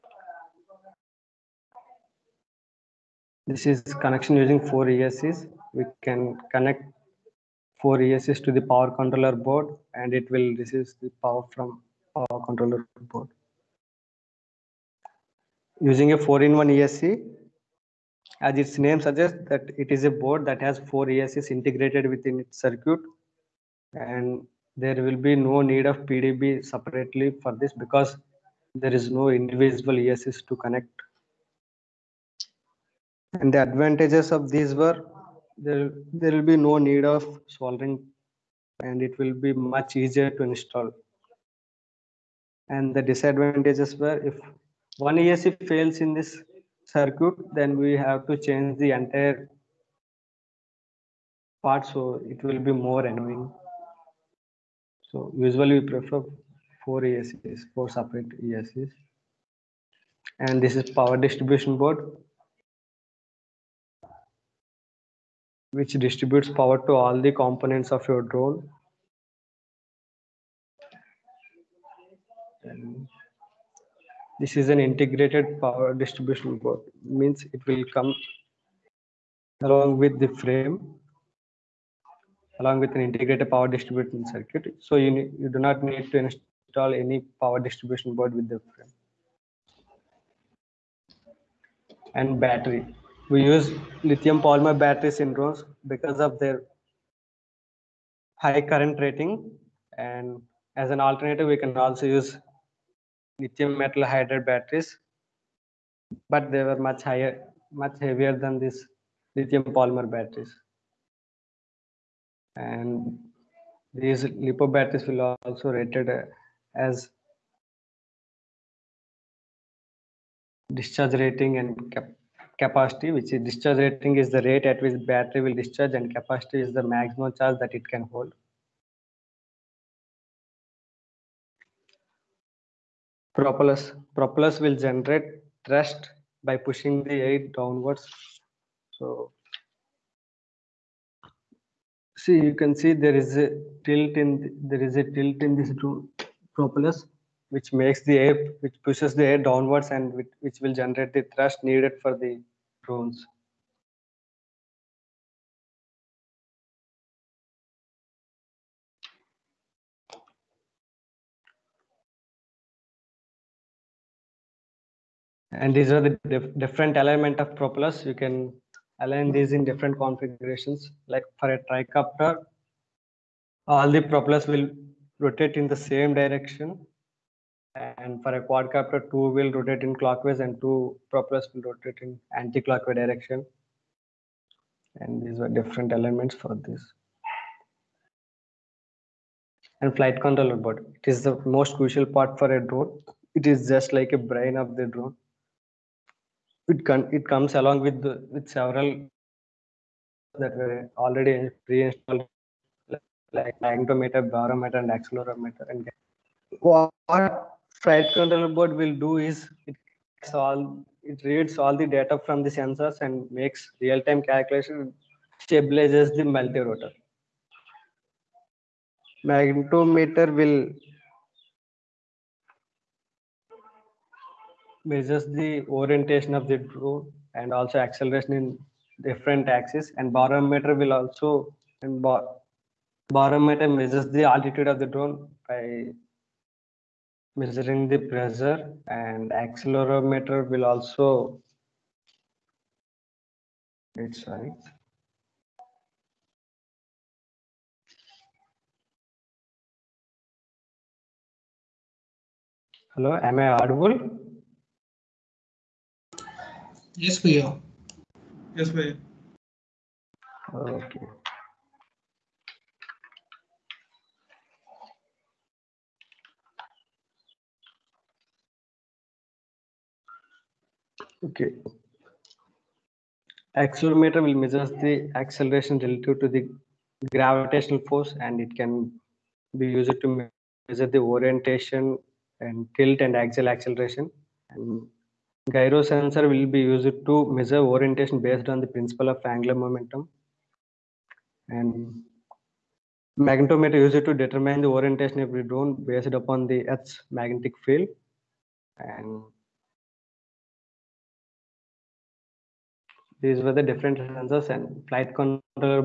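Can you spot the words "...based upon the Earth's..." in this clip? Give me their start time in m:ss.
4:55.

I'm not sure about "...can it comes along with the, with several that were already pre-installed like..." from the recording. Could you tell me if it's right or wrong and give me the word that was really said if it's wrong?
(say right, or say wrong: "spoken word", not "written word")
right.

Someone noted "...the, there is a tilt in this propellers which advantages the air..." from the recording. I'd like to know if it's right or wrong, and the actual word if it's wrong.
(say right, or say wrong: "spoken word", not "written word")
wrong: "makes", not "advantages".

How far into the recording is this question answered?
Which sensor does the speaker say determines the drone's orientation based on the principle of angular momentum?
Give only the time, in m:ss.
4:45.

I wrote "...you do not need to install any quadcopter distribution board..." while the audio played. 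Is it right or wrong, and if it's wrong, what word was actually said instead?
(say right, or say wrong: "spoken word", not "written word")
wrong: "power", not "quadcopter".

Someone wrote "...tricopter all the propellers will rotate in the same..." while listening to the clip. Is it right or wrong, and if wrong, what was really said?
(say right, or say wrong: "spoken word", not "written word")
right.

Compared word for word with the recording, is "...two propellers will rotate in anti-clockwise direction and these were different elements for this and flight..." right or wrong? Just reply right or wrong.
right.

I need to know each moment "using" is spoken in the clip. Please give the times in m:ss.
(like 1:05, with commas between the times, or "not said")
0:04, 0:15.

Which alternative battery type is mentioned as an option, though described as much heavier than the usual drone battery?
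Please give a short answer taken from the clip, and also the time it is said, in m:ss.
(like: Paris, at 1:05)
Lithium metal hydride, at 1:43.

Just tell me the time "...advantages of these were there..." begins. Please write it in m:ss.
0:33.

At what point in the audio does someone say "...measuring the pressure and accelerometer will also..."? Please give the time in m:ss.
3:57.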